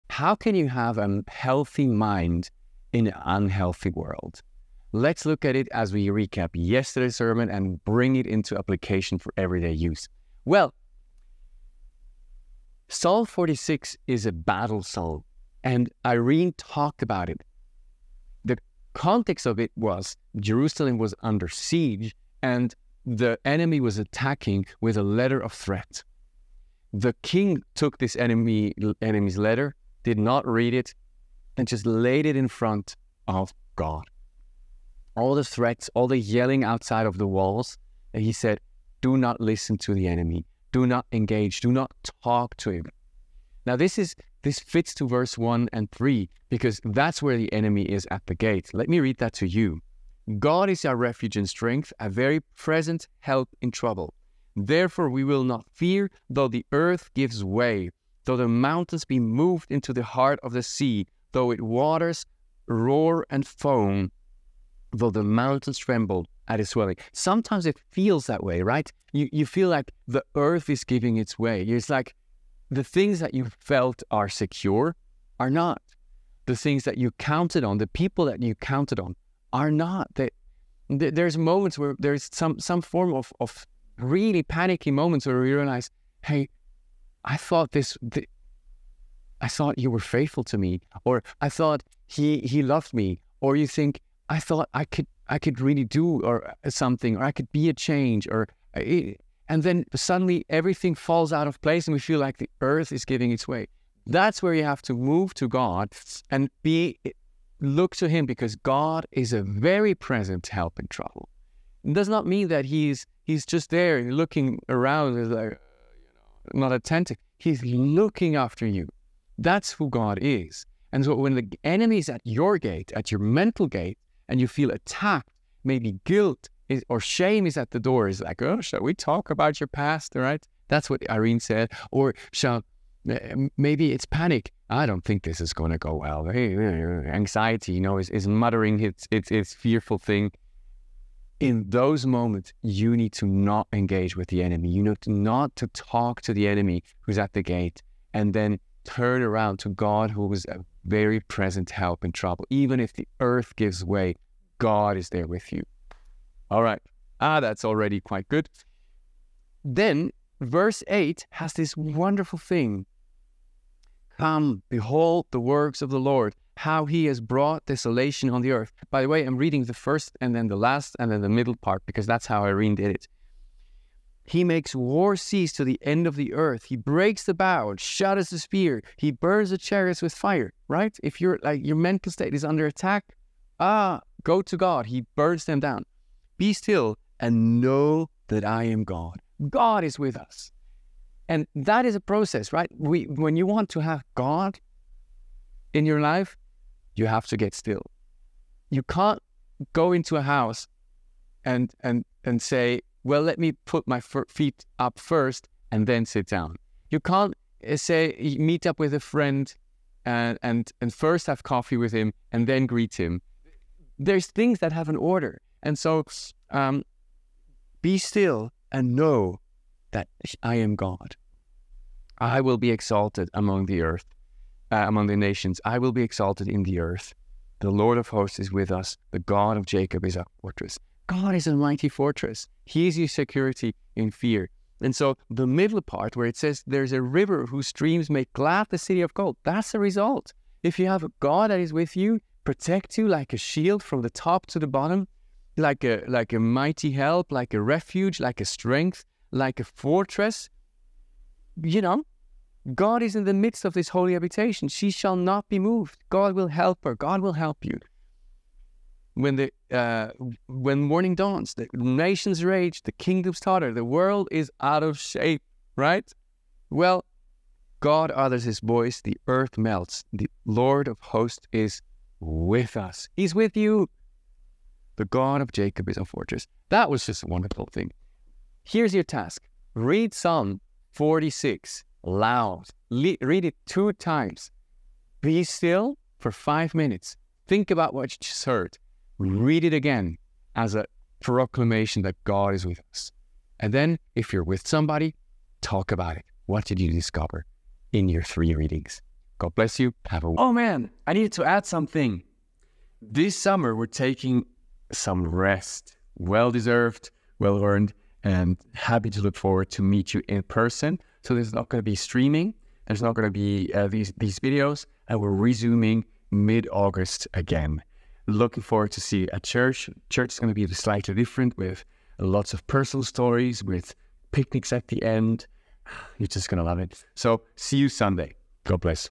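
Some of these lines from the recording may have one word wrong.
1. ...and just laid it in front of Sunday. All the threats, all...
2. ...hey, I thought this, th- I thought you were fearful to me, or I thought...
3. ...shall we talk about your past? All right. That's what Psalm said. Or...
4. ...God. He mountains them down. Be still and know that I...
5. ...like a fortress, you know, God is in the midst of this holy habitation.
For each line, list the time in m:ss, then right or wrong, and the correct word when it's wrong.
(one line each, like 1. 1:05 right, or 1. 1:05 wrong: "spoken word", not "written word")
1. 0:31 wrong: "God", not "Sunday"
2. 1:26 wrong: "faithful", not "fearful"
3. 2:08 wrong: "Irene", not "Psalm"
4. 3:04 wrong: "burns", not "mountains"
5. 4:09 right.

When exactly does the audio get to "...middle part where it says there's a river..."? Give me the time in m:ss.
3:55.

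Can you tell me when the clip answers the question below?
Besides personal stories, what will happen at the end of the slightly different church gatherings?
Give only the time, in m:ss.
5:24.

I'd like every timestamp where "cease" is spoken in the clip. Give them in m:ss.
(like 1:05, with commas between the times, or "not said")
2:55.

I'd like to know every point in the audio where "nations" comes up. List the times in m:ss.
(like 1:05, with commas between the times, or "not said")
3:45, 4:21.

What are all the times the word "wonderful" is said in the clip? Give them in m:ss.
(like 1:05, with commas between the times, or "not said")
2:41, 4:37.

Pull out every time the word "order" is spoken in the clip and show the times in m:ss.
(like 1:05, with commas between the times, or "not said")
3:34.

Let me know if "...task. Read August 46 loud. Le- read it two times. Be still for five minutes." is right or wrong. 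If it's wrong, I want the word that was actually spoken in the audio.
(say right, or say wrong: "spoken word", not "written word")
wrong: "Psalm", not "August".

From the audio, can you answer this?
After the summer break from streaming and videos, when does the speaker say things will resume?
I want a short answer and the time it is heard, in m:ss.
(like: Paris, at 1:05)
mid August, at 5:16.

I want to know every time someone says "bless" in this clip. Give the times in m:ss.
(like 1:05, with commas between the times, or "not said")
4:59, 5:28.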